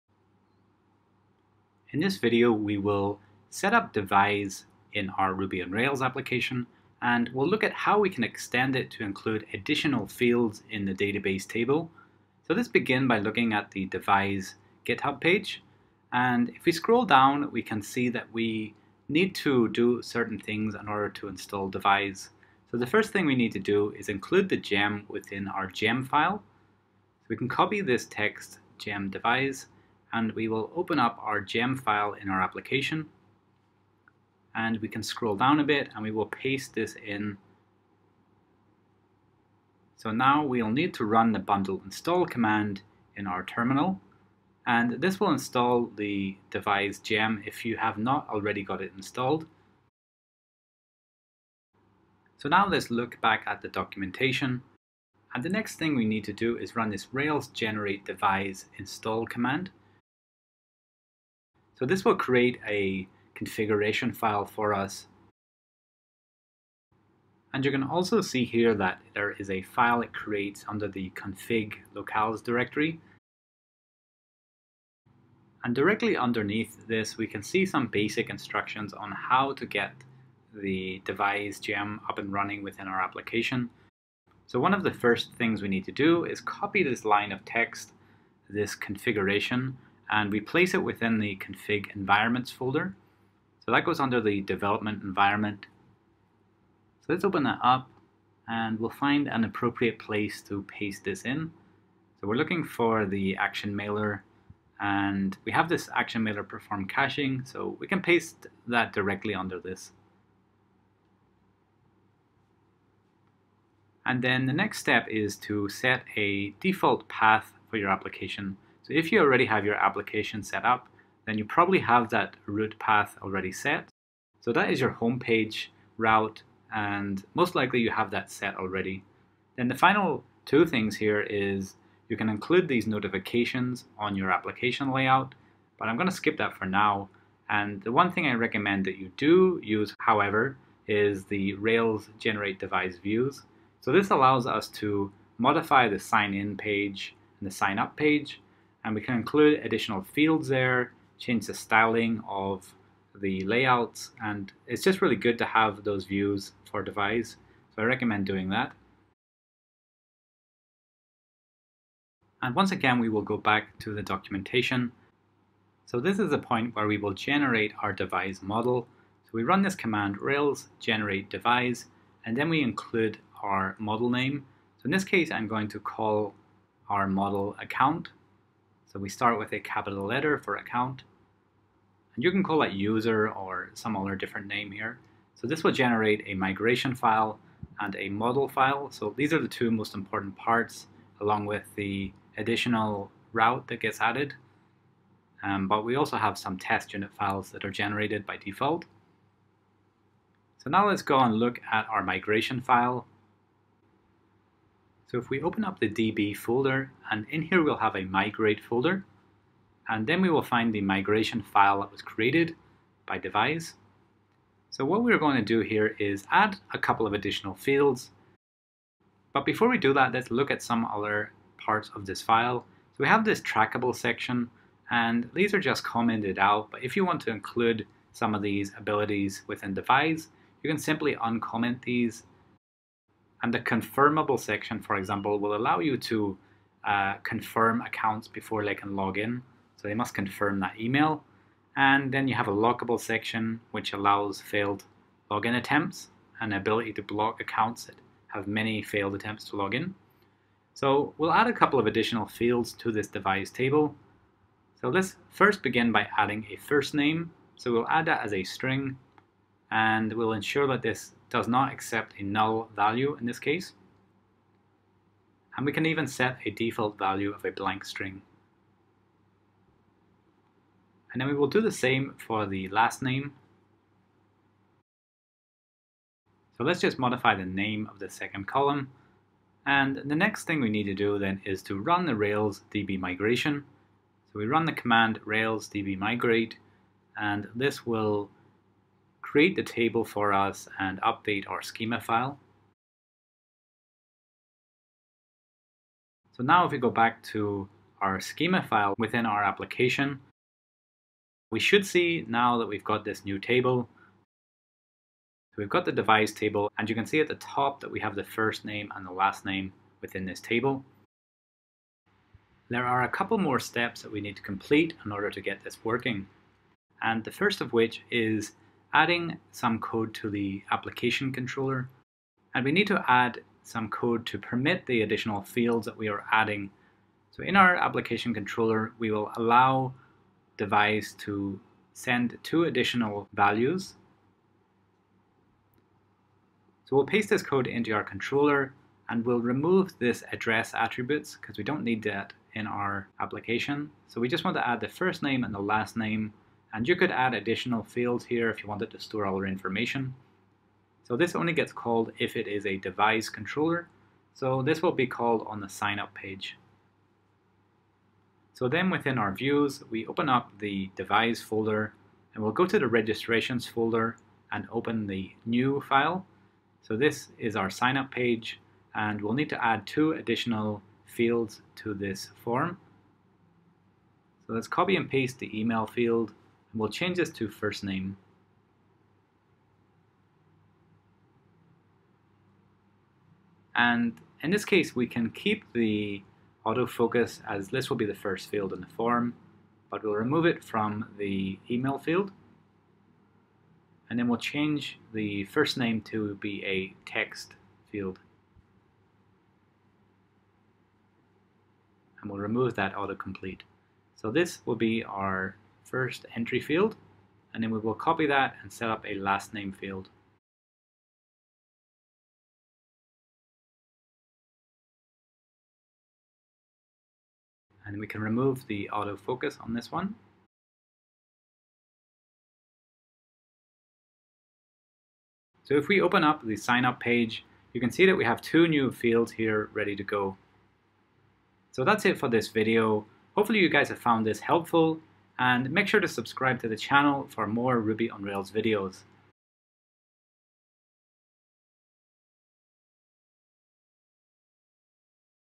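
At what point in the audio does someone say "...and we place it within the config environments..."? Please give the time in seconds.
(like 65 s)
90 s.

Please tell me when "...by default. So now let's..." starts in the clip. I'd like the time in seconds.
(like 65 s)
198 s.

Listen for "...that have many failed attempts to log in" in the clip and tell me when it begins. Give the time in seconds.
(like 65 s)
247 s.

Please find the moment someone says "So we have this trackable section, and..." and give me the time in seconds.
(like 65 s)
222 s.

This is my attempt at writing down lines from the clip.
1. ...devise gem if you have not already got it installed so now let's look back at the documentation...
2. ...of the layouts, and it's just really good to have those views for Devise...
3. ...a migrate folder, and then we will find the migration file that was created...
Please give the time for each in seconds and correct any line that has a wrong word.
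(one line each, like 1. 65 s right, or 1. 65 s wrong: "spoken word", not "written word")
1. 46 s right
2. 152 s right
3. 207 s right.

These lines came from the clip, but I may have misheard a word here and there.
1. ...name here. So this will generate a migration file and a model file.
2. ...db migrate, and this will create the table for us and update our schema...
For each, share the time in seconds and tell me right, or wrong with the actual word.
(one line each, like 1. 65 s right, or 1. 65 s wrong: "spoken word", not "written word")
1. 184 s right
2. 285 s right.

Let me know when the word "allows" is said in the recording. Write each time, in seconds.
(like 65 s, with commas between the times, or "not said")
144 s, 235 s, 243 s, 329 s.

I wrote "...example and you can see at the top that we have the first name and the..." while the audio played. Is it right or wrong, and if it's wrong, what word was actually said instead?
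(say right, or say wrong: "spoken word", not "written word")
wrong: "table", not "example".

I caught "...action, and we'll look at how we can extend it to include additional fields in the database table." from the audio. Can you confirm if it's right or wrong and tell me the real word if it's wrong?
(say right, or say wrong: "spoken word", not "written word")
wrong: "application", not "action".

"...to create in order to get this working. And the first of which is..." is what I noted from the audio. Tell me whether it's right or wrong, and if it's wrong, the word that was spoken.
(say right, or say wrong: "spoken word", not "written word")
wrong: "complete", not "create".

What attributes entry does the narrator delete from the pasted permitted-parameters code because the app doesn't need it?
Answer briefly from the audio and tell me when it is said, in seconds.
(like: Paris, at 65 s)
address attributes, at 340 s.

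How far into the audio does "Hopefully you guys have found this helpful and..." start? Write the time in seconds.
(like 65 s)
433 s.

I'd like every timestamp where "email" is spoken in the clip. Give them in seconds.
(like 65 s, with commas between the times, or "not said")
240 s, 375 s, 391 s.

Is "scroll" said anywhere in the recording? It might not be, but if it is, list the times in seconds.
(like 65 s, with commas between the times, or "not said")
16 s, 35 s.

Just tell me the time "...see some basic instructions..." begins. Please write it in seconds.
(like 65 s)
77 s.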